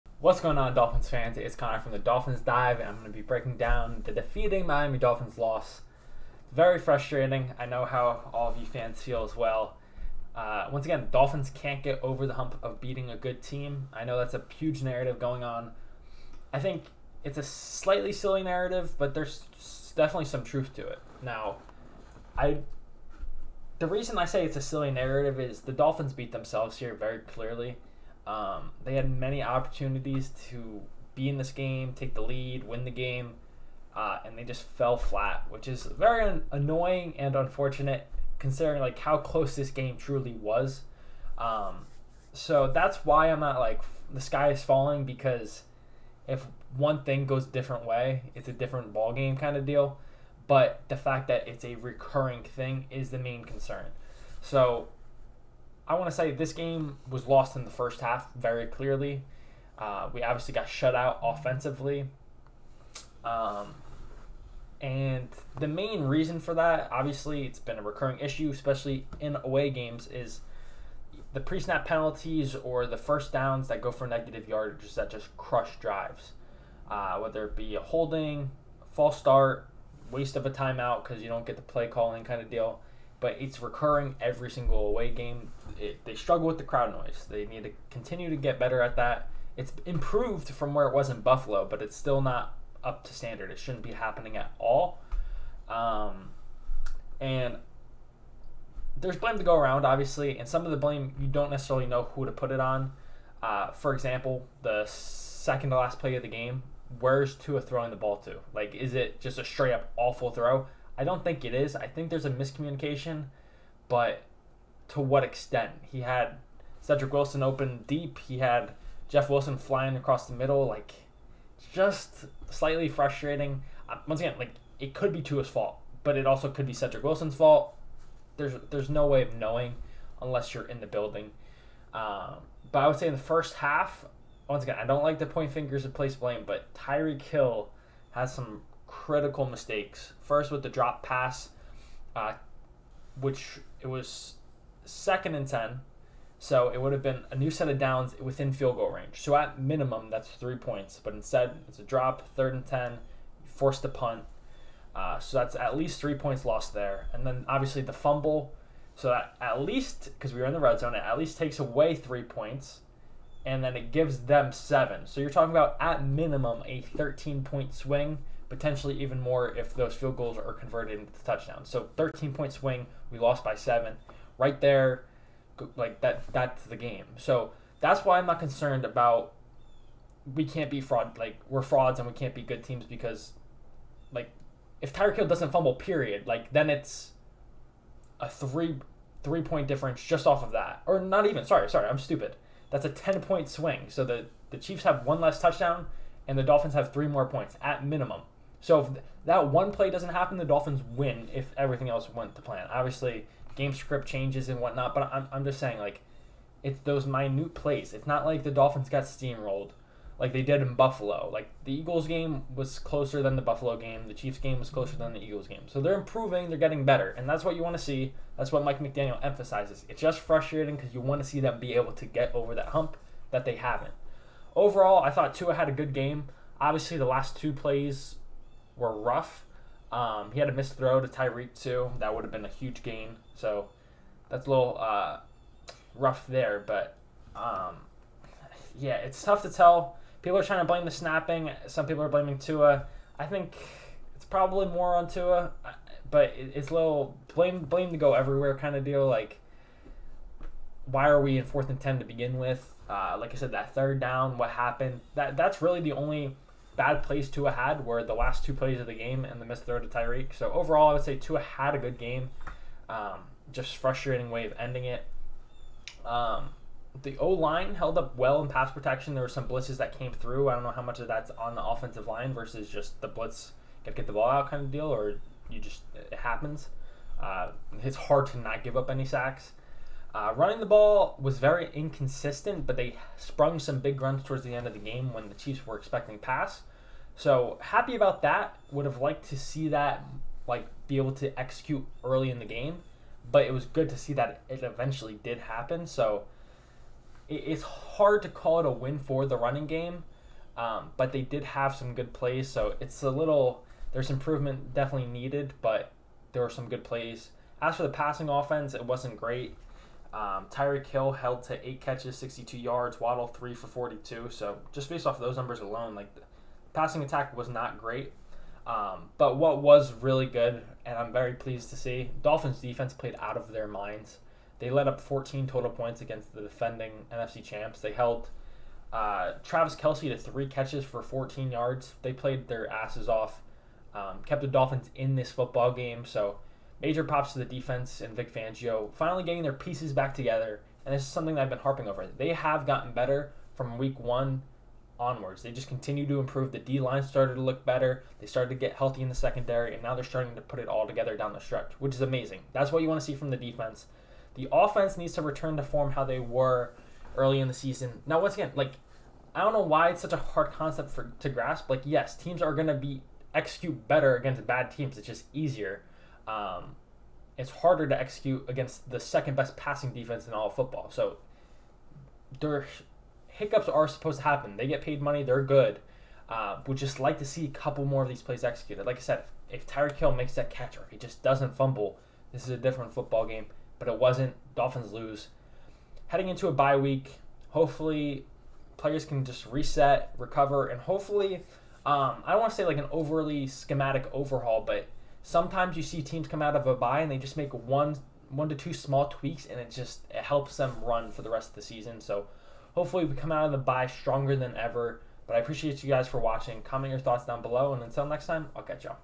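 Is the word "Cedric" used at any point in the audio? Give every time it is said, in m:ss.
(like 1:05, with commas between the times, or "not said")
1:56, 2:06.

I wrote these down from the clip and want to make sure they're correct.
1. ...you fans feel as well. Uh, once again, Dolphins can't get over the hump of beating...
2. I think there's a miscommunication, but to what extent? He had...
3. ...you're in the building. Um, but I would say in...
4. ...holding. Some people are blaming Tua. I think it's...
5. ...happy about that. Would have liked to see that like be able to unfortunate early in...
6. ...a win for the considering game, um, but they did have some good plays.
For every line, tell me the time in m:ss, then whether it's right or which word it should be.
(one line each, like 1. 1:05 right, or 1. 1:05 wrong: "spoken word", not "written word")
1. 0:08 right
2. 1:51 right
3. 2:10 right
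4. 4:00 wrong: "snapping", not "holding"
5. 4:47 wrong: "execute", not "unfortunate"
6. 4:58 wrong: "running", not "considering".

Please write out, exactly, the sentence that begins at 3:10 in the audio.
Or not even, sorry, sorry, I'm stupid.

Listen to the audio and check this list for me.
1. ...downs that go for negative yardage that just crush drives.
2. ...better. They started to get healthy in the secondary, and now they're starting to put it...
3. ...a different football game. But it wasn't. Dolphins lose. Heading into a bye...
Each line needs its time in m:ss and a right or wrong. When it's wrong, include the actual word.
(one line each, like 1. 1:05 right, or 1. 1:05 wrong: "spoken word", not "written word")
1. 1:13 right
2. 5:47 right
3. 6:22 right.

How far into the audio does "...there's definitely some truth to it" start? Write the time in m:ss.
0:19.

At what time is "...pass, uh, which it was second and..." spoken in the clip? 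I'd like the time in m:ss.
2:21.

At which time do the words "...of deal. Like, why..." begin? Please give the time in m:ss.
4:08.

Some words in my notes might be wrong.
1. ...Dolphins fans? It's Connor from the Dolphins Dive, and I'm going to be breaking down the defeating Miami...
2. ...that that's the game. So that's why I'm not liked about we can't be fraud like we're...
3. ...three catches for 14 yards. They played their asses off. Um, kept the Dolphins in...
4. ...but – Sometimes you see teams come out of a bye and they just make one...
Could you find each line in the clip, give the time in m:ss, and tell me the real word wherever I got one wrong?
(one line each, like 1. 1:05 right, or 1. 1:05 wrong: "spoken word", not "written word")
1. 0:00 right
2. 2:56 wrong: "concerned", not "liked"
3. 5:30 right
4. 6:34 right.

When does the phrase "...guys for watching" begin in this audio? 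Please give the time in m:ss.
6:45.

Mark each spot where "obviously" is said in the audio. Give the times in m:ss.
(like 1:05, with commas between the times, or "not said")
1:00, 1:06, 1:39, 2:37, 3:22, 3:46.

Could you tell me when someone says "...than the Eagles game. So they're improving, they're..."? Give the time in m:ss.
3:34.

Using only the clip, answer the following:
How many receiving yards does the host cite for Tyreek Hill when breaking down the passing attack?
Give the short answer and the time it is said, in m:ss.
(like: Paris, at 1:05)
62, at 5:12.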